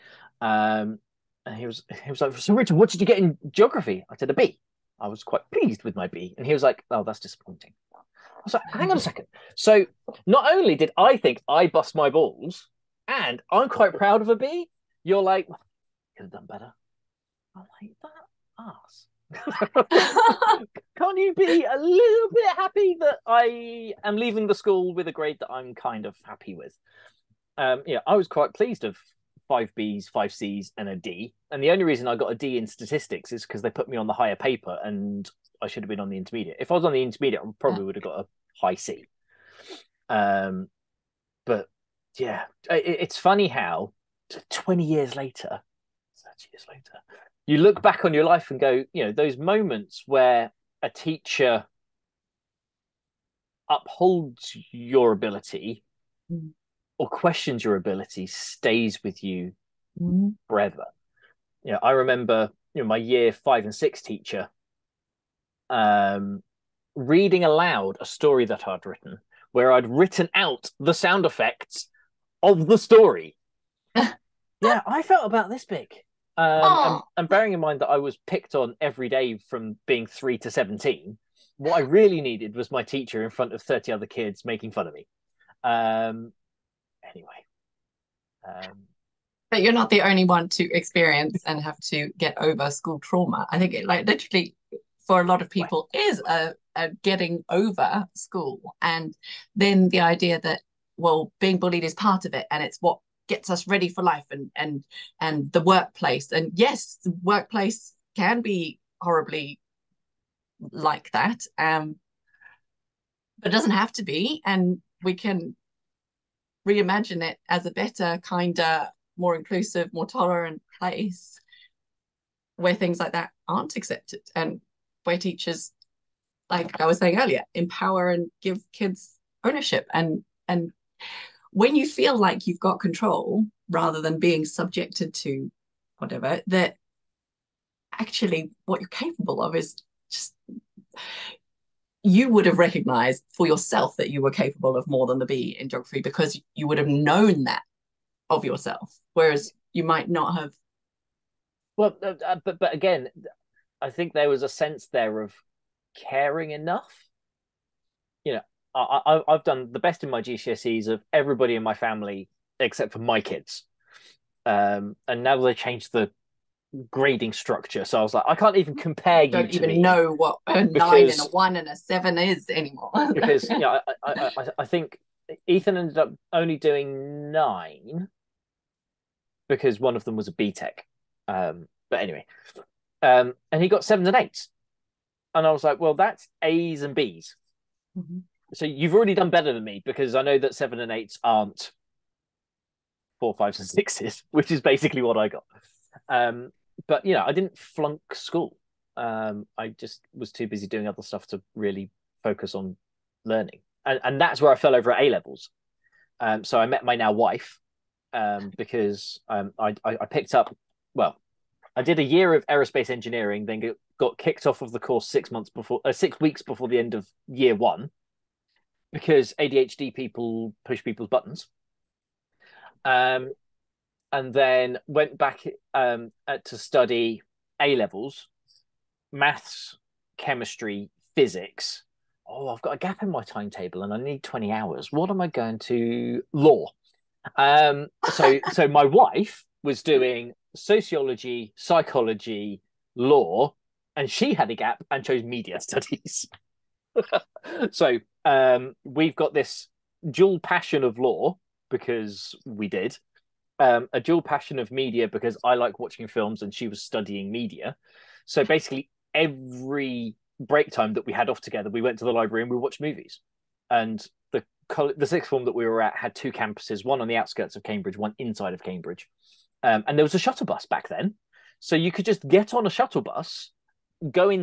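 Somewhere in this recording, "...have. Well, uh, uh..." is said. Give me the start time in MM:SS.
02:30.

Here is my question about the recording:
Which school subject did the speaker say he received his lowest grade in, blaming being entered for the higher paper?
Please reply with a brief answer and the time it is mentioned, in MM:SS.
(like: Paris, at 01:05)
Statistics, at 00:32.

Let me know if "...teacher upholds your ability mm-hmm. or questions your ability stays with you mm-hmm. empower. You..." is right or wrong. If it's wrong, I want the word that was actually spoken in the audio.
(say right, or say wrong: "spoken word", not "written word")
wrong: "forever", not "empower".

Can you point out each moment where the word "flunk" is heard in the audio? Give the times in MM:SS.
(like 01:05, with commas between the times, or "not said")
03:17.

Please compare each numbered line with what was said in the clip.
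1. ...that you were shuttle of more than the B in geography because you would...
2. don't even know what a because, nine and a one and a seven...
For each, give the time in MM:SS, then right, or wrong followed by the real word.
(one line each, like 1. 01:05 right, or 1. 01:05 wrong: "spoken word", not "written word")
1. 02:23 wrong: "capable", not "shuttle"
2. 02:49 right.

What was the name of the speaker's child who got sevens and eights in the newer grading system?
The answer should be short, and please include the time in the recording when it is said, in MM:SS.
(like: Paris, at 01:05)
Ethan, at 02:55.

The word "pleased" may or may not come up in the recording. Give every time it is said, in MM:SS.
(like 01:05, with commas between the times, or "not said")
00:05, 00:28.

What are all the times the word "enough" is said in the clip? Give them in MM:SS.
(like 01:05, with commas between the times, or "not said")
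02:36.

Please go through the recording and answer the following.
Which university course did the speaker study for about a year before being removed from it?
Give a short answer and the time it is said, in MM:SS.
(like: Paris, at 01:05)
Aerospace engineering, at 03:32.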